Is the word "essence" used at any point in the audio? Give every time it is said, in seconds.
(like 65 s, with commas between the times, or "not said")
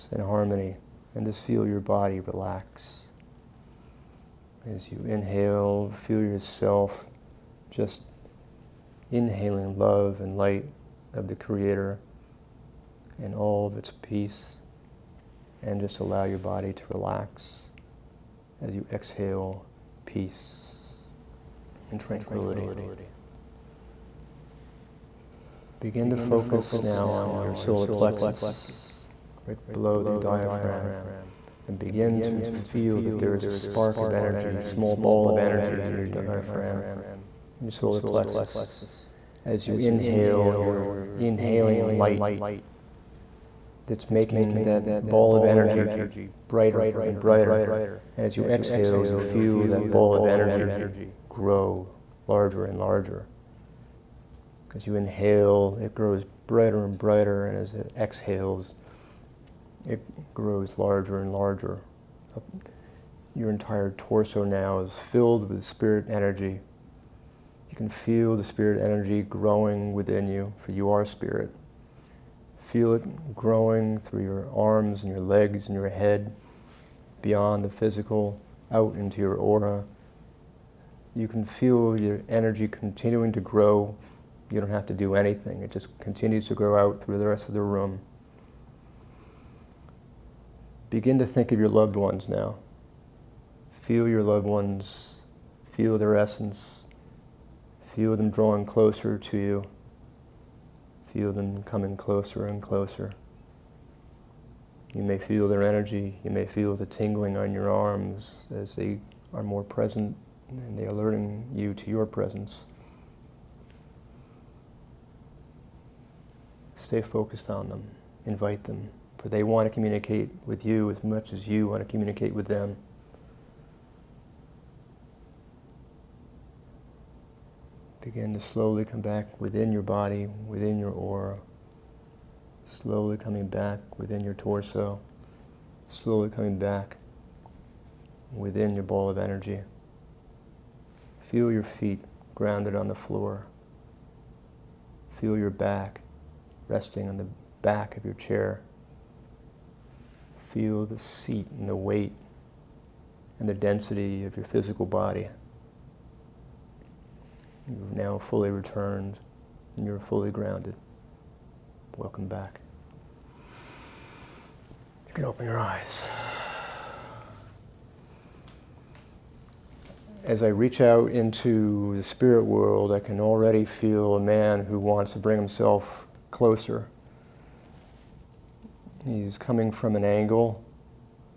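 96 s.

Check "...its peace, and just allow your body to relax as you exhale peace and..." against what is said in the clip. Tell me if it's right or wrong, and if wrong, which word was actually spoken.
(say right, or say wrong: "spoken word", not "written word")
right.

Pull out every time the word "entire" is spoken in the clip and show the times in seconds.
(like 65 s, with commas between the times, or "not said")
63 s.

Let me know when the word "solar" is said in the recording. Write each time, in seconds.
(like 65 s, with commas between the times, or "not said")
27 s, 37 s.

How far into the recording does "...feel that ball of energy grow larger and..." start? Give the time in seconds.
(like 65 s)
49 s.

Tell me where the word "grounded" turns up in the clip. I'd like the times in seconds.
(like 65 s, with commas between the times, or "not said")
142 s, 160 s.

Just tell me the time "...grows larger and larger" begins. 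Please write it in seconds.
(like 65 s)
60 s.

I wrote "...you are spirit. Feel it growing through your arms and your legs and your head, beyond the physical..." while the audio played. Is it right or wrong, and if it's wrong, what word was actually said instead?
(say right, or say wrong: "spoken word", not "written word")
right.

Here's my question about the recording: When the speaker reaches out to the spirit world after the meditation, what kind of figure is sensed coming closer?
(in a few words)
a man.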